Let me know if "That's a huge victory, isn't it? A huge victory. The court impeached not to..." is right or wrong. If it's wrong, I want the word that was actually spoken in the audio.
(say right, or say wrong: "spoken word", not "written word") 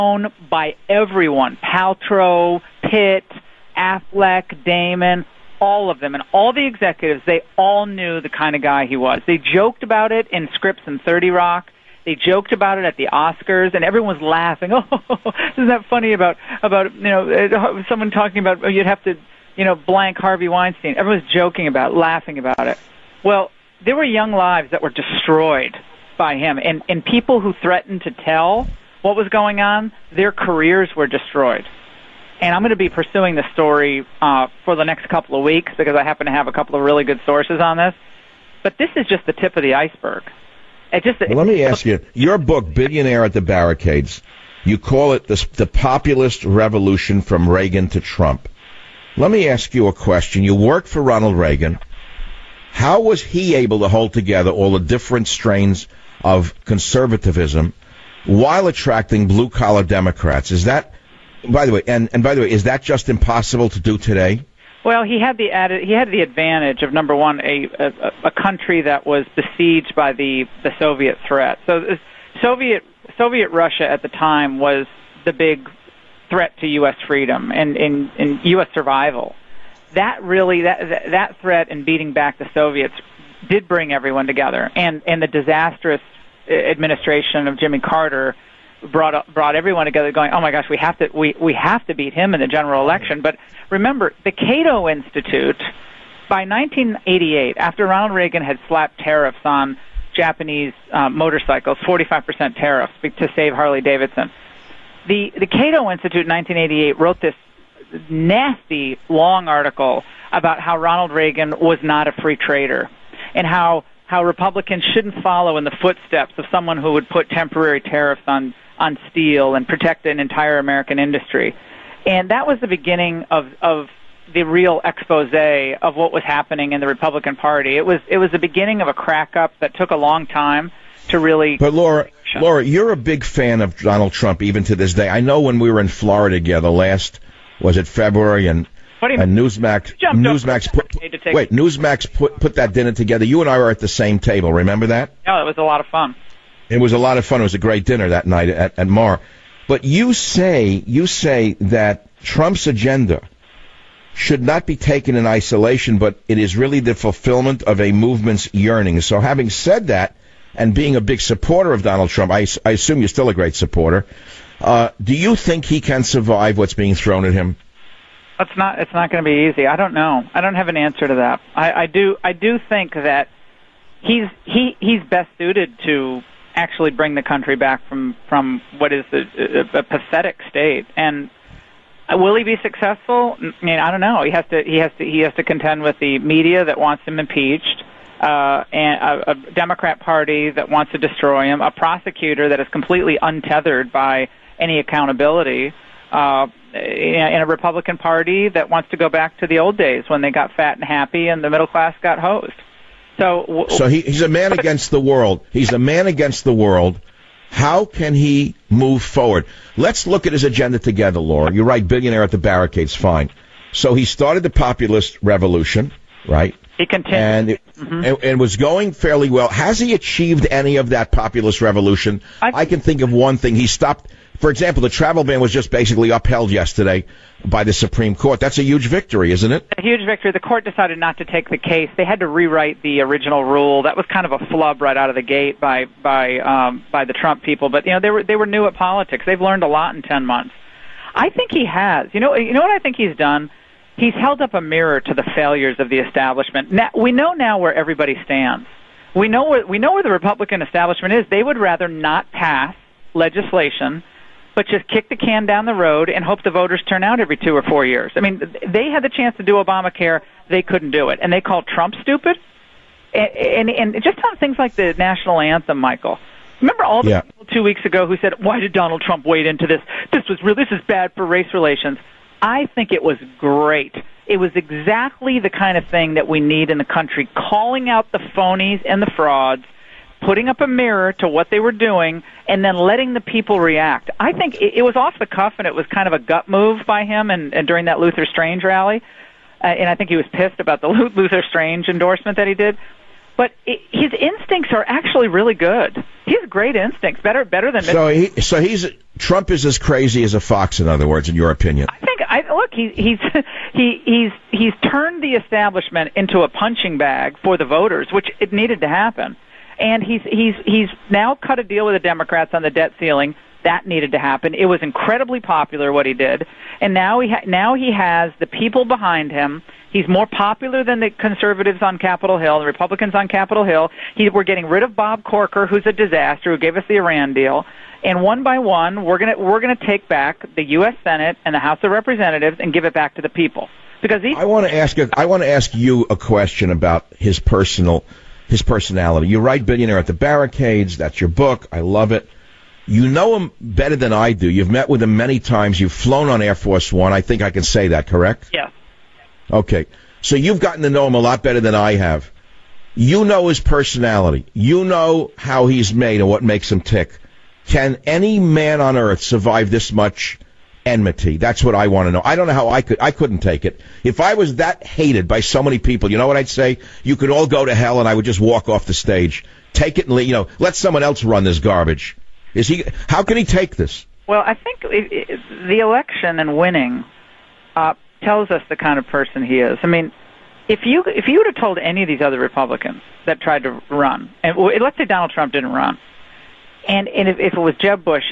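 wrong: "decided", not "impeached".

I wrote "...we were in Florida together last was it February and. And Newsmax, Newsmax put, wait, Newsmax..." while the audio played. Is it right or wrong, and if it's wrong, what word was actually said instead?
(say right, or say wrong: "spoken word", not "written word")
right.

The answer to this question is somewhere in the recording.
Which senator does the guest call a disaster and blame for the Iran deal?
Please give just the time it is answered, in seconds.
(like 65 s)
324 s.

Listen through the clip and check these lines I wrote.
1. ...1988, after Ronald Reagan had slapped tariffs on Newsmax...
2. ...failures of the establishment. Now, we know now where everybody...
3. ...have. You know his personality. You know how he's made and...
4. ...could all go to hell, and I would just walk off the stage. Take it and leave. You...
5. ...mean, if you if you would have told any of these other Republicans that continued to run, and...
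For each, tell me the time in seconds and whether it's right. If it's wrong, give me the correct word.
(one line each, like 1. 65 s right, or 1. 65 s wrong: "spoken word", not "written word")
1. 96 s wrong: "Japanese", not "Newsmax"
2. 245 s right
3. 351 s right
4. 367 s right
5. 379 s wrong: "tried", not "continued".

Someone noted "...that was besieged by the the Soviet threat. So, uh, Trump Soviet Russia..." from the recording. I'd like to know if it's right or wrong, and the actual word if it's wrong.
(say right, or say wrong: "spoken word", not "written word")
wrong: "Soviet", not "Trump".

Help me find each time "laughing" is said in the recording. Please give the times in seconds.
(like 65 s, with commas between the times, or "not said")
14 s, 21 s.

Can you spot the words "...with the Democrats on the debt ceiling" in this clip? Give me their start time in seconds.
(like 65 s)
311 s.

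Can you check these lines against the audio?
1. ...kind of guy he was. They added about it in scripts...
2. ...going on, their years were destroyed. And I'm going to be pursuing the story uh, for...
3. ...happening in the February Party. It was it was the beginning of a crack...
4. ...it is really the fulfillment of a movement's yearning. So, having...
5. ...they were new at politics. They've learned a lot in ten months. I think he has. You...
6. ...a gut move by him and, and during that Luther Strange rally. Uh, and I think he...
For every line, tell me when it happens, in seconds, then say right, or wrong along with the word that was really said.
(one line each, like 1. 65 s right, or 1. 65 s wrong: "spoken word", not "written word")
1. 8 s wrong: "joked", not "added"
2. 29 s wrong: "careers", not "years"
3. 126 s wrong: "Republican", not "February"
4. 156 s right
5. 238 s right
6. 286 s right.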